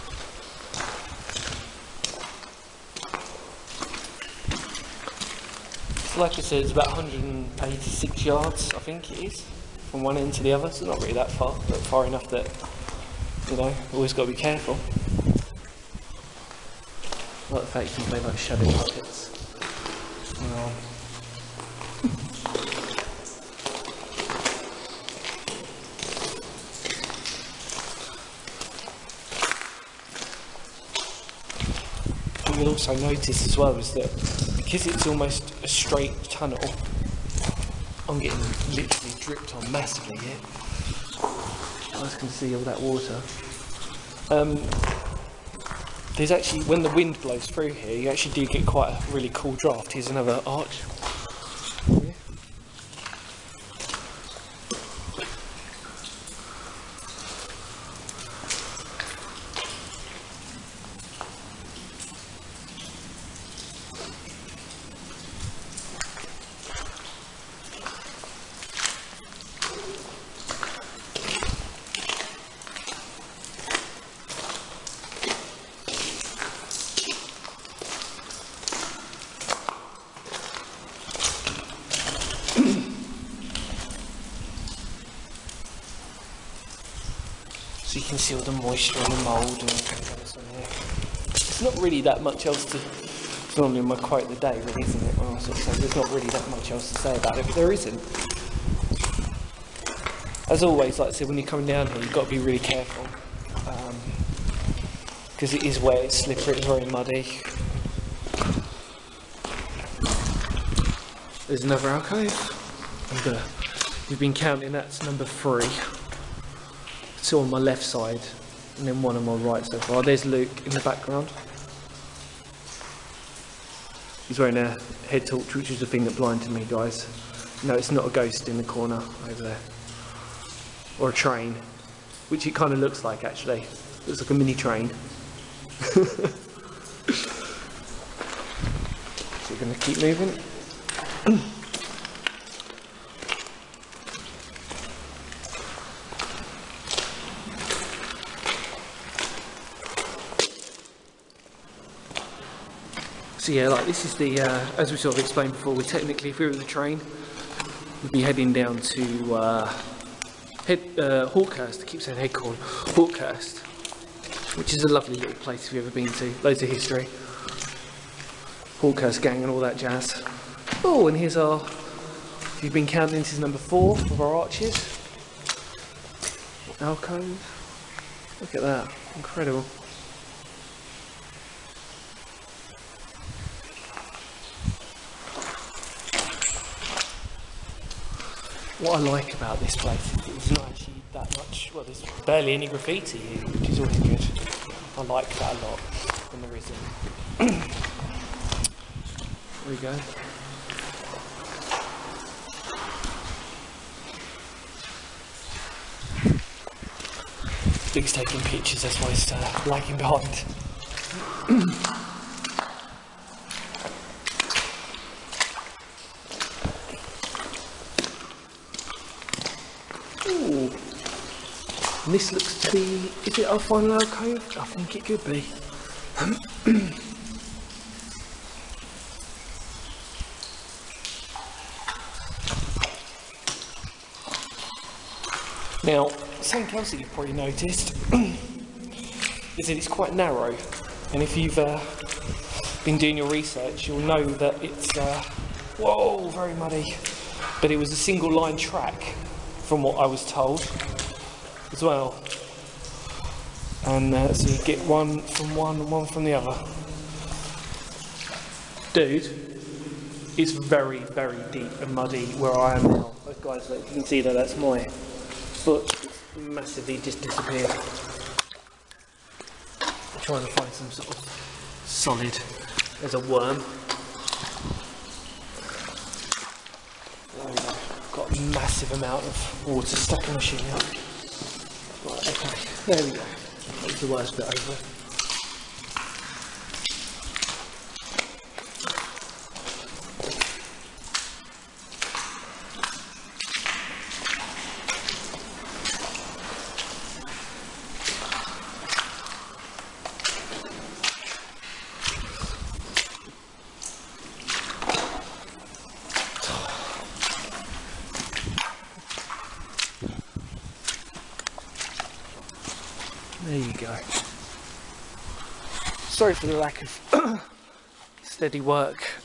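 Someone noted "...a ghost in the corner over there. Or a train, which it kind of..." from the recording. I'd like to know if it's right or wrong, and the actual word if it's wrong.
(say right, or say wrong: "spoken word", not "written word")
right.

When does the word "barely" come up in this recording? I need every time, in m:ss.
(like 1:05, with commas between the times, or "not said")
3:12.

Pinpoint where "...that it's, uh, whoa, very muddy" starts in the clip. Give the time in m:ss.
4:04.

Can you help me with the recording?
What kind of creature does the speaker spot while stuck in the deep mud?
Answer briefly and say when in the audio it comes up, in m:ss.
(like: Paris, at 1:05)
A worm, at 4:33.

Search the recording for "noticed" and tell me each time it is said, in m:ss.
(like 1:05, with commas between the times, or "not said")
0:32, 3:57.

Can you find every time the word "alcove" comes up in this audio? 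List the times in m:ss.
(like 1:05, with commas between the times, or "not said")
1:51, 2:56, 3:43.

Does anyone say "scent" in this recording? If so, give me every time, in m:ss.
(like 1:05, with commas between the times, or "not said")
not said.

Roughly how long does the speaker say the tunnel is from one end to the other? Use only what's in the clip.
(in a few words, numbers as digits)
186 yards.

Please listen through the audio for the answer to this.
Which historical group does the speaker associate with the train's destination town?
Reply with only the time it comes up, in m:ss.
2:48.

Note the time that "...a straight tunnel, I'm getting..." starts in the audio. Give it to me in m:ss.
0:35.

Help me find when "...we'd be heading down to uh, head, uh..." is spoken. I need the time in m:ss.
2:38.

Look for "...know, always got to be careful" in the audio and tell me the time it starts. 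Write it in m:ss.
0:13.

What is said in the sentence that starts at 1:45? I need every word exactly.
Because um, it is wet, it's slippery, it's very muddy.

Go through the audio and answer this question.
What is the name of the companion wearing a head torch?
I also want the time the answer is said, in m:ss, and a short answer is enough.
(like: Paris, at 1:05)
Luke, at 2:00.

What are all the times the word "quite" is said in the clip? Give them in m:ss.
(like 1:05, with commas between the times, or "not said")
0:48, 3:59.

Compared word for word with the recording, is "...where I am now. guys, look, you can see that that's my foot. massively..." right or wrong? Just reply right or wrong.
right.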